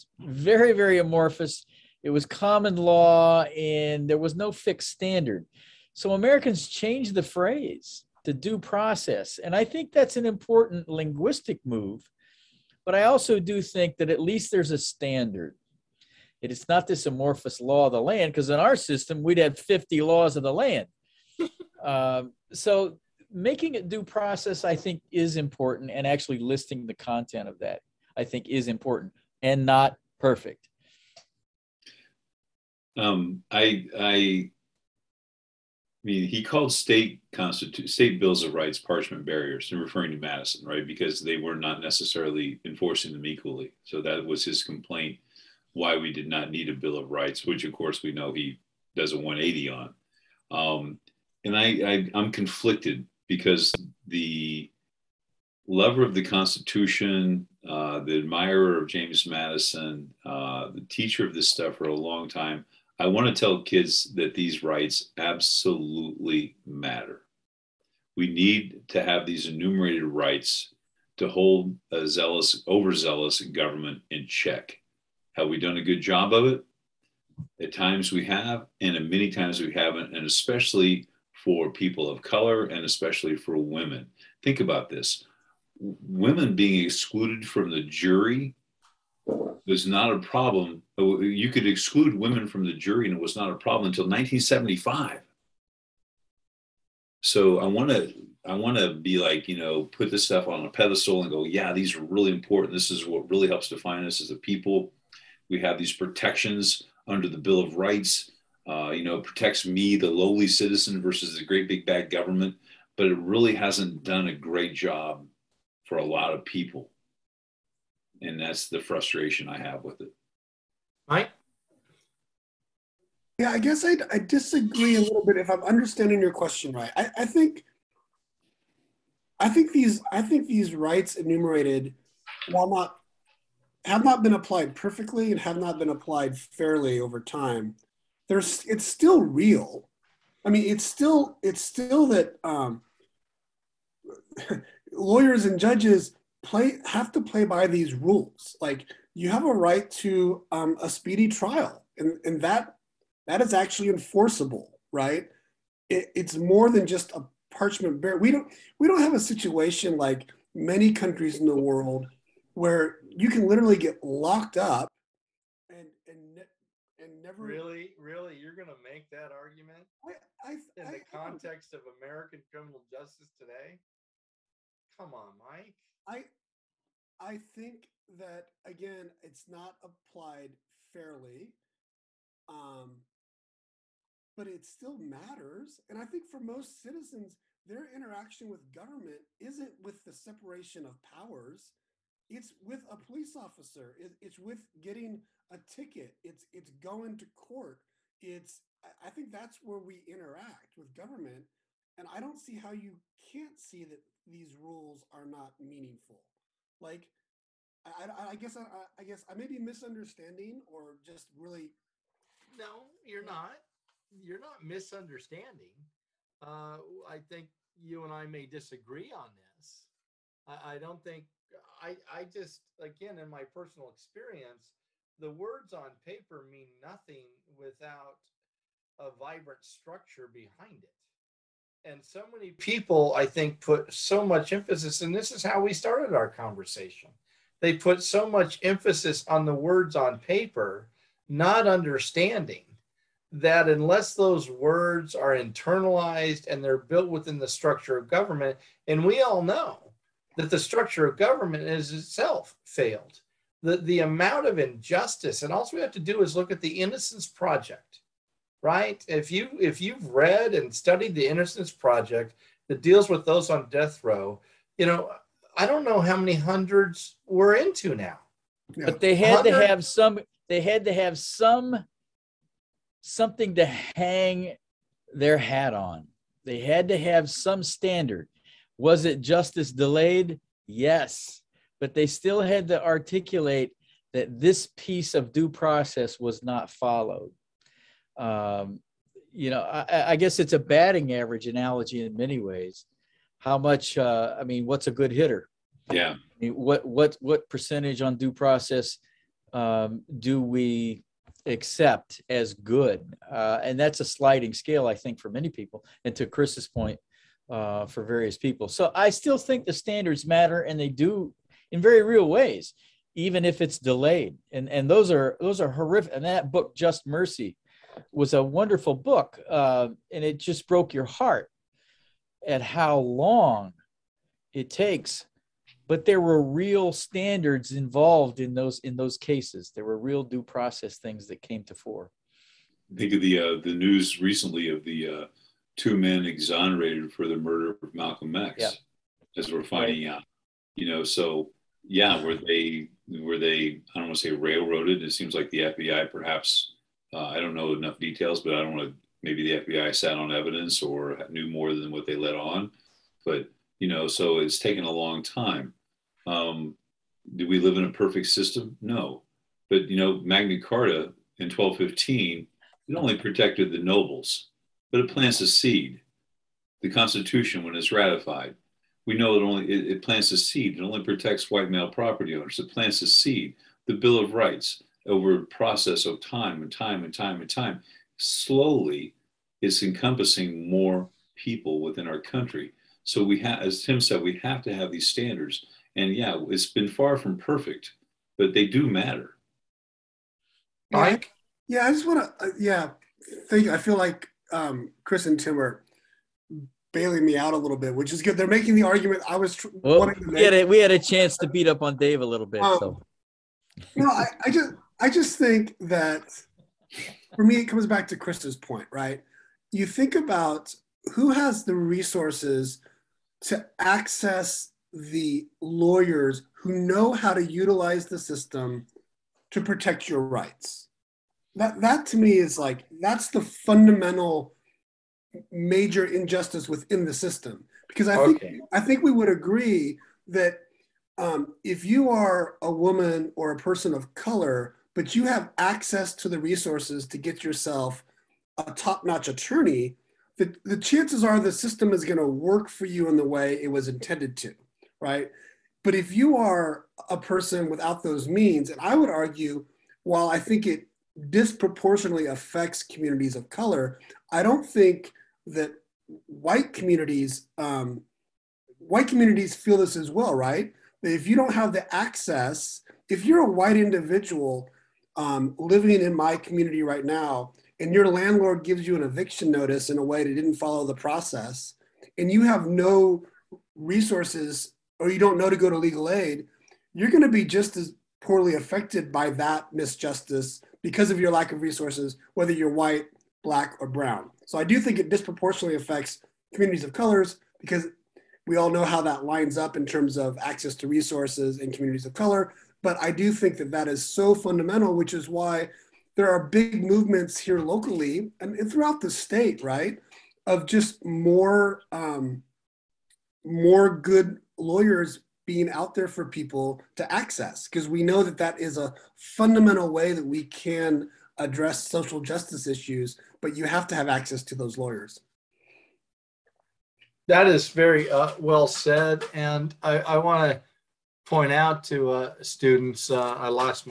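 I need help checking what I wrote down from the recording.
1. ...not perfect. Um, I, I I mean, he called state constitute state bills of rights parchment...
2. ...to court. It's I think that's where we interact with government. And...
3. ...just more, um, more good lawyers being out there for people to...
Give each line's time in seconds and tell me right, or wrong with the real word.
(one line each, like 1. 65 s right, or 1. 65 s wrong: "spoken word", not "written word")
1. 29 s right
2. 197 s right
3. 500 s right.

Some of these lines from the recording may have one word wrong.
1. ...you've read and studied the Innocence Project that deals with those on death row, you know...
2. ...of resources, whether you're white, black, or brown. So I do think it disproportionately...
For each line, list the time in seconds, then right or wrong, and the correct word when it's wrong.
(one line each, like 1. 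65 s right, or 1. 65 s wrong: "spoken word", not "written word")
1. 259 s right
2. 481 s right.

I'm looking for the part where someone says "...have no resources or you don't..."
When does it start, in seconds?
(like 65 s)
472 s.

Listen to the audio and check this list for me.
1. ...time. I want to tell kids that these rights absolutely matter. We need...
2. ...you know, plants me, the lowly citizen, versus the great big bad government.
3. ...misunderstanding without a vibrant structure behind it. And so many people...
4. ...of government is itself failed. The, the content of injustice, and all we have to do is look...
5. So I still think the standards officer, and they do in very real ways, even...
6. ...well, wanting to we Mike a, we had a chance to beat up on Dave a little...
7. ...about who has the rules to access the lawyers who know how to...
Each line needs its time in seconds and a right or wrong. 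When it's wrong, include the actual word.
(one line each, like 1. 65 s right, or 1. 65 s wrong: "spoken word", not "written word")
1. 62 s right
2. 108 s wrong: "protects", not "plants"
3. 226 s wrong: "nothing", not "misunderstanding"
4. 251 s wrong: "amount", not "content"
5. 308 s wrong: "matter", not "officer"
6. 399 s wrong: "Had", not "Mike"
7. 410 s wrong: "resources", not "rules".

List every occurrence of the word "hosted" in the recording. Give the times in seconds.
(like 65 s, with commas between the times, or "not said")
not said.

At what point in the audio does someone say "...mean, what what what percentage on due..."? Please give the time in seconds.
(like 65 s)
296 s.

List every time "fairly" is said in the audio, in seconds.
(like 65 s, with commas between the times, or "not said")
136 s, 180 s.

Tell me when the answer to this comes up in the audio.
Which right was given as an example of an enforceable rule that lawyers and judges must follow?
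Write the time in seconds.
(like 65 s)
150 s.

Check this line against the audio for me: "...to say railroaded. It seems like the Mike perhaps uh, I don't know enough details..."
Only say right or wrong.
wrong.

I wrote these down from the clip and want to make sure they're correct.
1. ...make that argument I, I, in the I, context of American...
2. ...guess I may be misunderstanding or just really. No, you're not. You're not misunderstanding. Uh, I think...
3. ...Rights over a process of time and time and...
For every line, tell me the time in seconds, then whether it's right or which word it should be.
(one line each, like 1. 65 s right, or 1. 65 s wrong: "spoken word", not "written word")
1. 168 s right
2. 209 s right
3. 374 s right.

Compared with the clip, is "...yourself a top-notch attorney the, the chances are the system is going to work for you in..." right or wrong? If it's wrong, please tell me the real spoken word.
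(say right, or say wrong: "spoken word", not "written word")
right.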